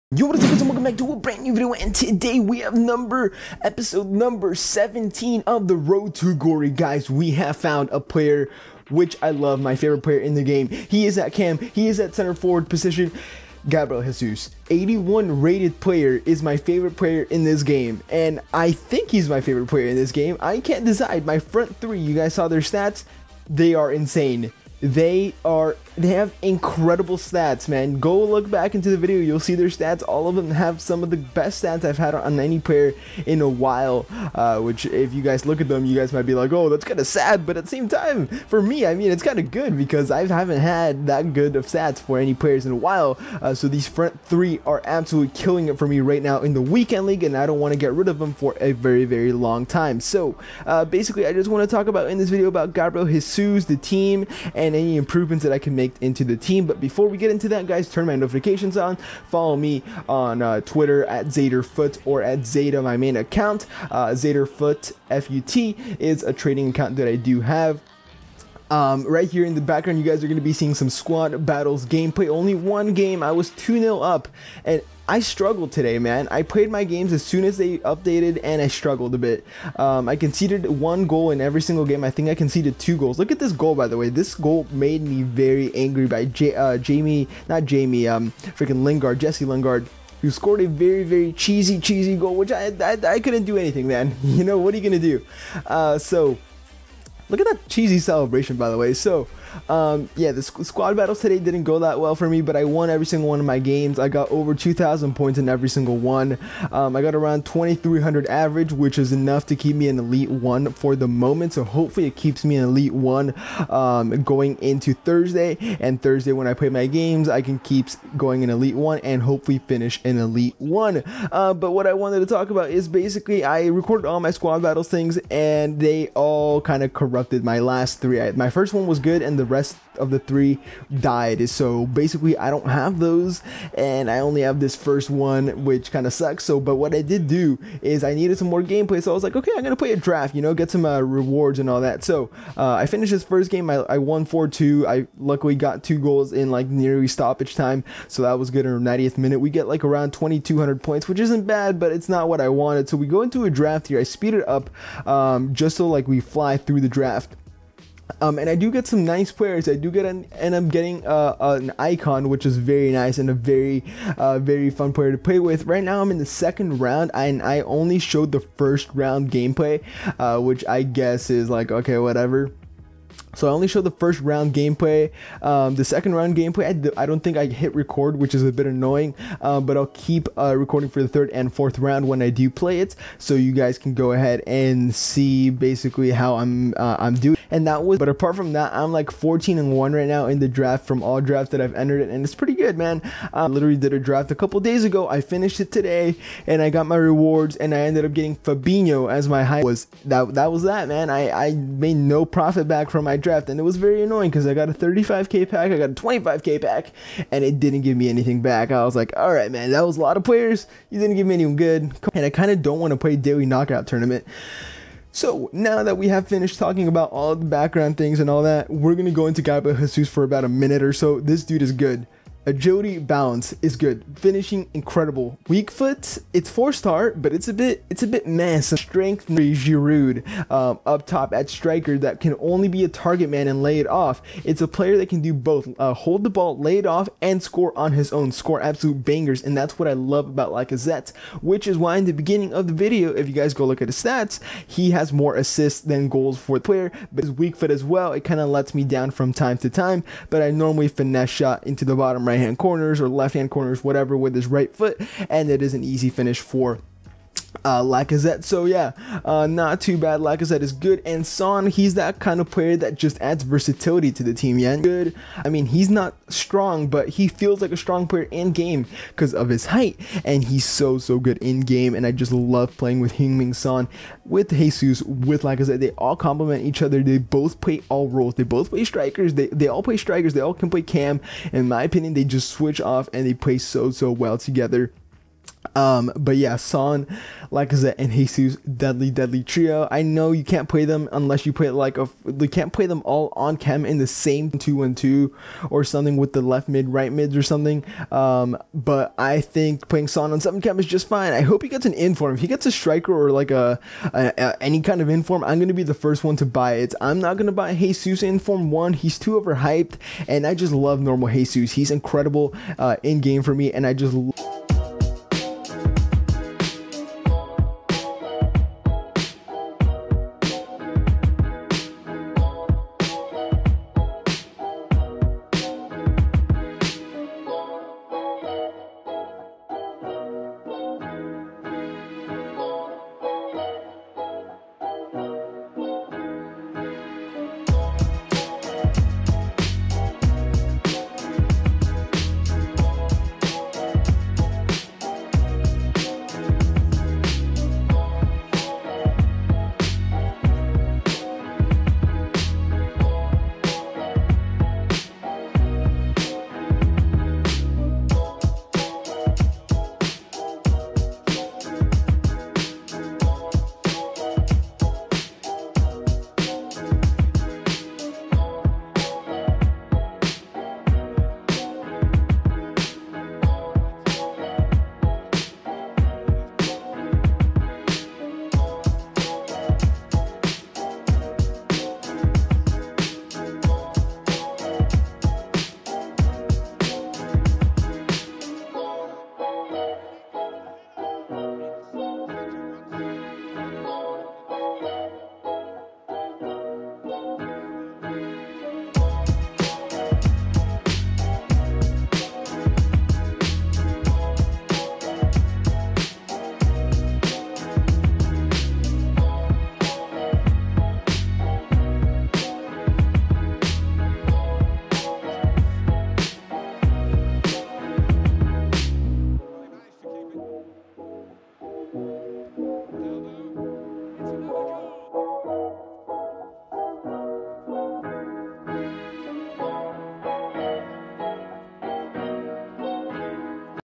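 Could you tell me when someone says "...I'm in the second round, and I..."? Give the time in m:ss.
2:46.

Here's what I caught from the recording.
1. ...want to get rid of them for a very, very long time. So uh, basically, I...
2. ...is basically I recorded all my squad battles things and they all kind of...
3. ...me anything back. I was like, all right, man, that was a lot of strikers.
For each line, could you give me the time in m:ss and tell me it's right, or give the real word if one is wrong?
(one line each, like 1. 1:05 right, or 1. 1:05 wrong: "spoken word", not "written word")
1. 0:47 right
2. 2:02 right
3. 3:27 wrong: "players", not "strikers".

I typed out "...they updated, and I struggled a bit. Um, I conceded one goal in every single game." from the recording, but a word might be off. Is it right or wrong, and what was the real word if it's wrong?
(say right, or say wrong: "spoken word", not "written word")
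right.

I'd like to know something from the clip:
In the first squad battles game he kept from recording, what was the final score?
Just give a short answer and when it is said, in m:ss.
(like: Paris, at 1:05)
4-2, at 2:24.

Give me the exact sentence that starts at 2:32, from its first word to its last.
So we go into a draft here.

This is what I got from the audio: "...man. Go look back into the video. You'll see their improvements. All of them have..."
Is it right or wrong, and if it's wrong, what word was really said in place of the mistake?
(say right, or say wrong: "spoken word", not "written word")
wrong: "stats", not "improvements".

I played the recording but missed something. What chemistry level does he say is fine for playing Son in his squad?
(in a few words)
7.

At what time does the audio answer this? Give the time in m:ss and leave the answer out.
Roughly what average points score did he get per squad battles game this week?
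1:47.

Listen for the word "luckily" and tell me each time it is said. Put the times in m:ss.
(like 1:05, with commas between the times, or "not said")
2:25.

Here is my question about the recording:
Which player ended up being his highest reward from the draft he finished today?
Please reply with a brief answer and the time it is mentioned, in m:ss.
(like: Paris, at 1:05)
Fabinho, at 3:18.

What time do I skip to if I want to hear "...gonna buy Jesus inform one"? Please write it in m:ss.
5:07.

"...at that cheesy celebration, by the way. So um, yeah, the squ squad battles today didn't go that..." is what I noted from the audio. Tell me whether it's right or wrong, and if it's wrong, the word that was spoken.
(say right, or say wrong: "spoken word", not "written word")
right.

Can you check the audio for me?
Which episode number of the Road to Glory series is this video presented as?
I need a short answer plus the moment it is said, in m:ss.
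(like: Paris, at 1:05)
17, at 0:03.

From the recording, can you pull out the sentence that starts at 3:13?
I literally did a draft a couple days ago.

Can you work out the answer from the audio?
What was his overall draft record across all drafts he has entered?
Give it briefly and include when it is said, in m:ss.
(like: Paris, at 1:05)
14 and one, at 3:09.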